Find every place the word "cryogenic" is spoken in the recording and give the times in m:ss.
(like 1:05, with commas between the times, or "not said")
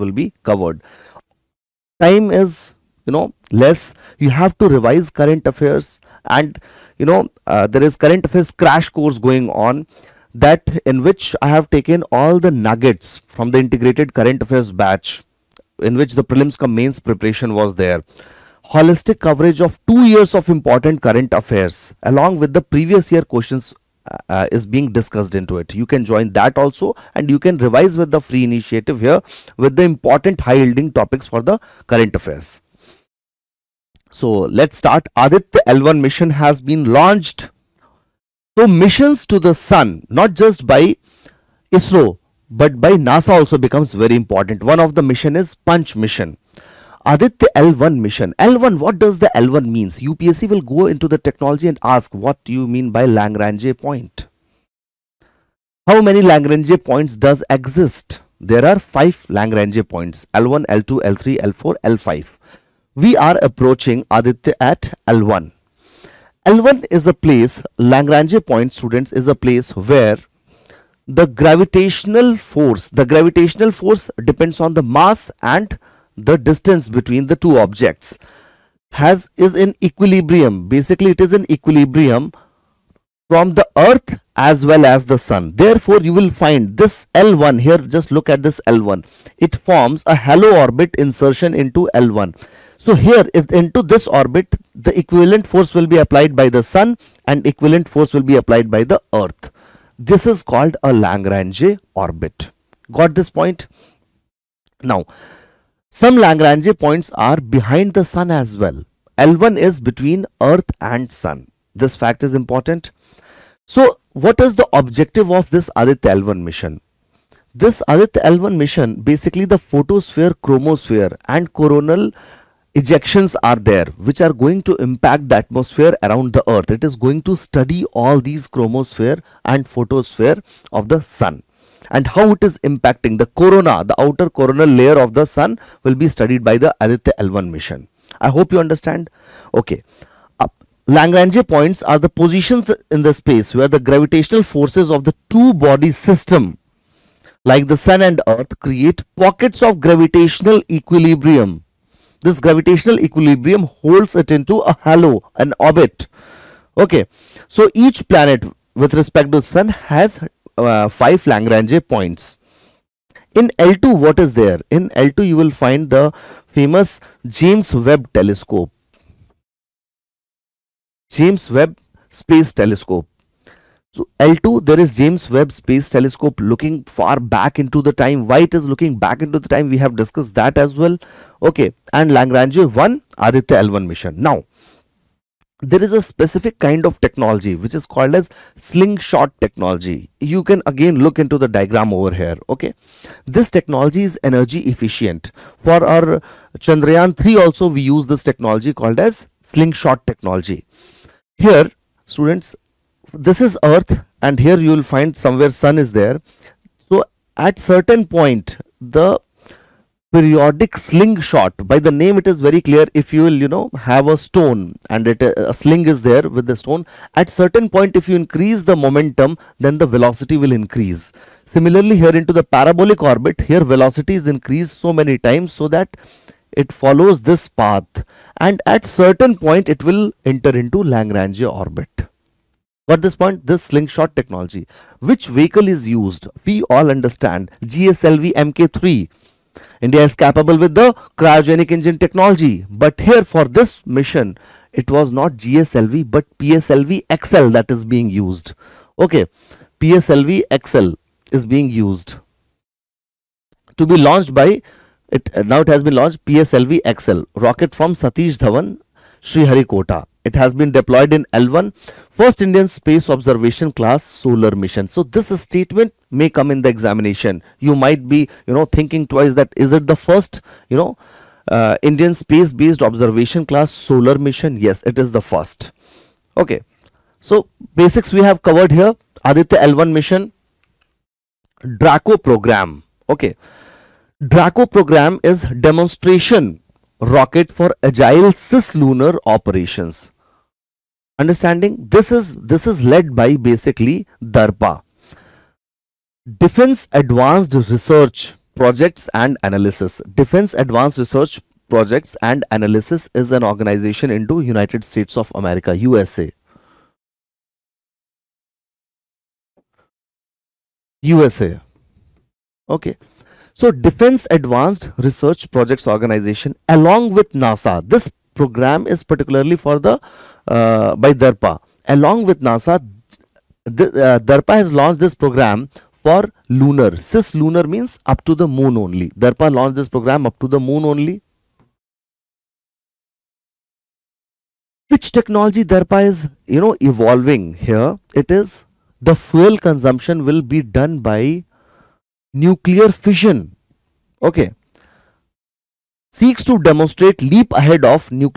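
4:01.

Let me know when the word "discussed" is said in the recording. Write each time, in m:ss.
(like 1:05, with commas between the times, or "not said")
0:24, 2:59.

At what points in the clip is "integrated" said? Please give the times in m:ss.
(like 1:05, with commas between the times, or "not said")
0:13.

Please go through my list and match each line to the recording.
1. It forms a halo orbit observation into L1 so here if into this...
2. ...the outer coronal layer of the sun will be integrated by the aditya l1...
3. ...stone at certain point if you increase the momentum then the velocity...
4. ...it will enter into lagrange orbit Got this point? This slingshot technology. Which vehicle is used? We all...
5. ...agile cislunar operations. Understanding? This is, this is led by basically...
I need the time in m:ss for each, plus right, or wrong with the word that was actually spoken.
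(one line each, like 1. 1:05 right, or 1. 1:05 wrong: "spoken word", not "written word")
1. 1:29 wrong: "insertion", not "observation"
2. 2:13 wrong: "studied", not "integrated"
3. 3:36 right
4. 3:49 right
5. 4:47 right.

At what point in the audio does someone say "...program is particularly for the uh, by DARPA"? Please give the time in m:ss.
5:18.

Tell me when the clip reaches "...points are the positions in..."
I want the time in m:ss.
2:21.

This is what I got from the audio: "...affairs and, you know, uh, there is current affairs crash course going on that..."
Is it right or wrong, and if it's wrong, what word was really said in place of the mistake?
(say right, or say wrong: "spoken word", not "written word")
right.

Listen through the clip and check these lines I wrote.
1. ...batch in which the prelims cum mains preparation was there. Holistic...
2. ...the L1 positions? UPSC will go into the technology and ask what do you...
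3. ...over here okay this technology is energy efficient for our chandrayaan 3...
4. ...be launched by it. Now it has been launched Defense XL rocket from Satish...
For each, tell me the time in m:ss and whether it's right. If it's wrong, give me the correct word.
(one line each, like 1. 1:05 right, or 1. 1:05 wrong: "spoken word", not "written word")
1. 0:14 right
2. 0:49 wrong: "means", not "positions"
3. 3:11 right
4. 4:13 wrong: "PSLV", not "Defense".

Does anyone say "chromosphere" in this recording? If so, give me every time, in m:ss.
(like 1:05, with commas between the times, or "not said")
2:00, 2:08.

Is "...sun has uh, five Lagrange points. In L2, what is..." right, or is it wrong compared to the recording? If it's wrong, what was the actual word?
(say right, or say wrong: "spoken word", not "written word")
right.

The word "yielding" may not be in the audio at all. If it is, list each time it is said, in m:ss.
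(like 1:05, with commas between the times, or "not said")
0:30.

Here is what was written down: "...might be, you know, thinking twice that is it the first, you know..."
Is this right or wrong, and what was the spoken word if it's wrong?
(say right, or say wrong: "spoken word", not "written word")
right.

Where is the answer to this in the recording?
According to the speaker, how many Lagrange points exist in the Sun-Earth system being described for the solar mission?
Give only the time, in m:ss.
0:58.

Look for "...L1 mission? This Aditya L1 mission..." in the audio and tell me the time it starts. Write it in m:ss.
1:56.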